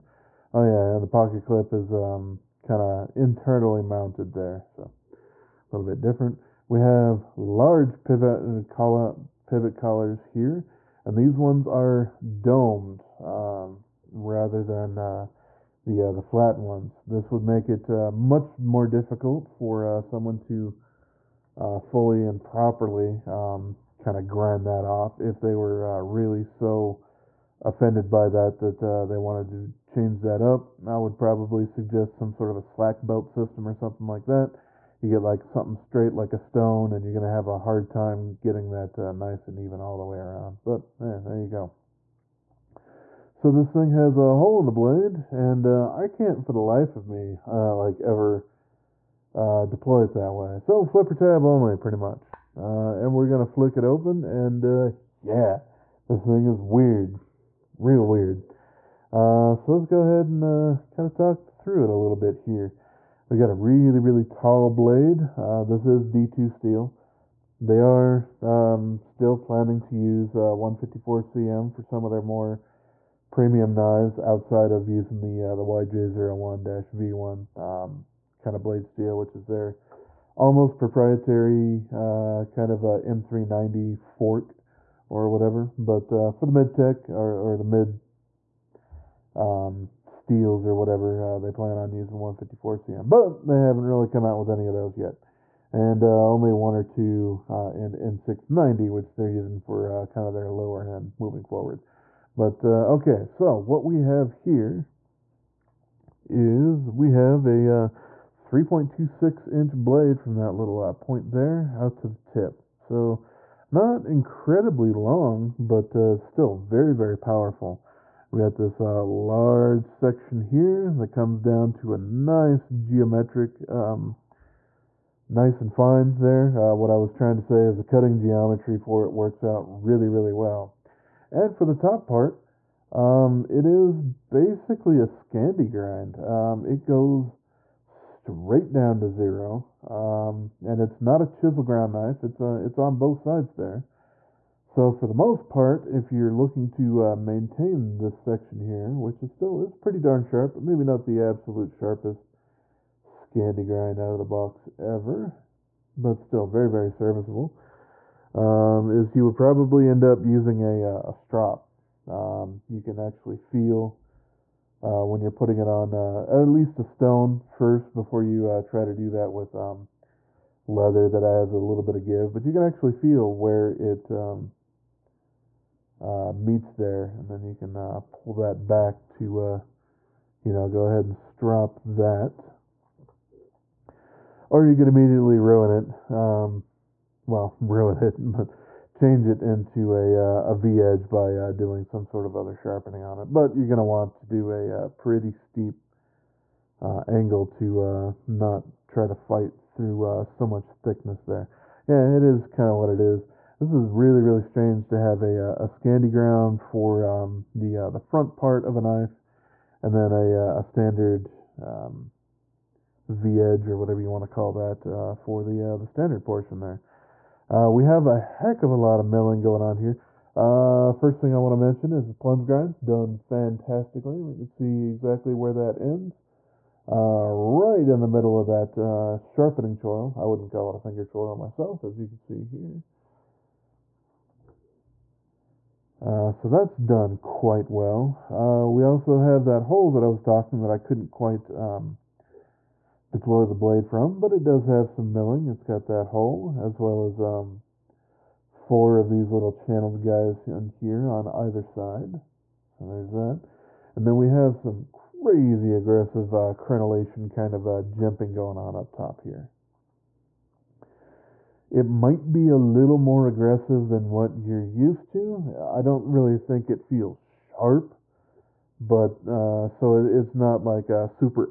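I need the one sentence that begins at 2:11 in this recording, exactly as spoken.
And for the top part, um, it is basically a Scandi grind.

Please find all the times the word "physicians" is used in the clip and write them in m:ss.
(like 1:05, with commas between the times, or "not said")
not said.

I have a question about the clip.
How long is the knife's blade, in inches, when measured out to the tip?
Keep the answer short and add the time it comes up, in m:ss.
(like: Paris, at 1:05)
3.26, at 1:48.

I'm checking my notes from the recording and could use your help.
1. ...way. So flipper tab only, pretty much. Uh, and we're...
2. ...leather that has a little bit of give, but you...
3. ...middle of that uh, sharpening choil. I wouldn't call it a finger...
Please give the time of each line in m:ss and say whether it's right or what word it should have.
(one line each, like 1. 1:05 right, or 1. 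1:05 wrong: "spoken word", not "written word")
1. 0:50 right
2. 2:50 right
3. 3:48 right.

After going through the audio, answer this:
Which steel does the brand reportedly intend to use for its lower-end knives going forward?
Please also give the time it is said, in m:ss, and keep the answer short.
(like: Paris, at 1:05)
N690, at 1:37.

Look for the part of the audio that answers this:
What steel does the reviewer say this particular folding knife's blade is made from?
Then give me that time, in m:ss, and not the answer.
1:06.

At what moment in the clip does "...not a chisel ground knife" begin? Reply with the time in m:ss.
2:21.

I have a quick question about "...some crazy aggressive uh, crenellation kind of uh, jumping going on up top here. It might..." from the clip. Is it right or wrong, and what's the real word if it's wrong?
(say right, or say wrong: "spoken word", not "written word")
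right.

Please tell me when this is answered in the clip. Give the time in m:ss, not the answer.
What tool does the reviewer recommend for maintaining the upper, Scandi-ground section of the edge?
2:41.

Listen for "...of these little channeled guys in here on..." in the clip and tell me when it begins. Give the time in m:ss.
4:08.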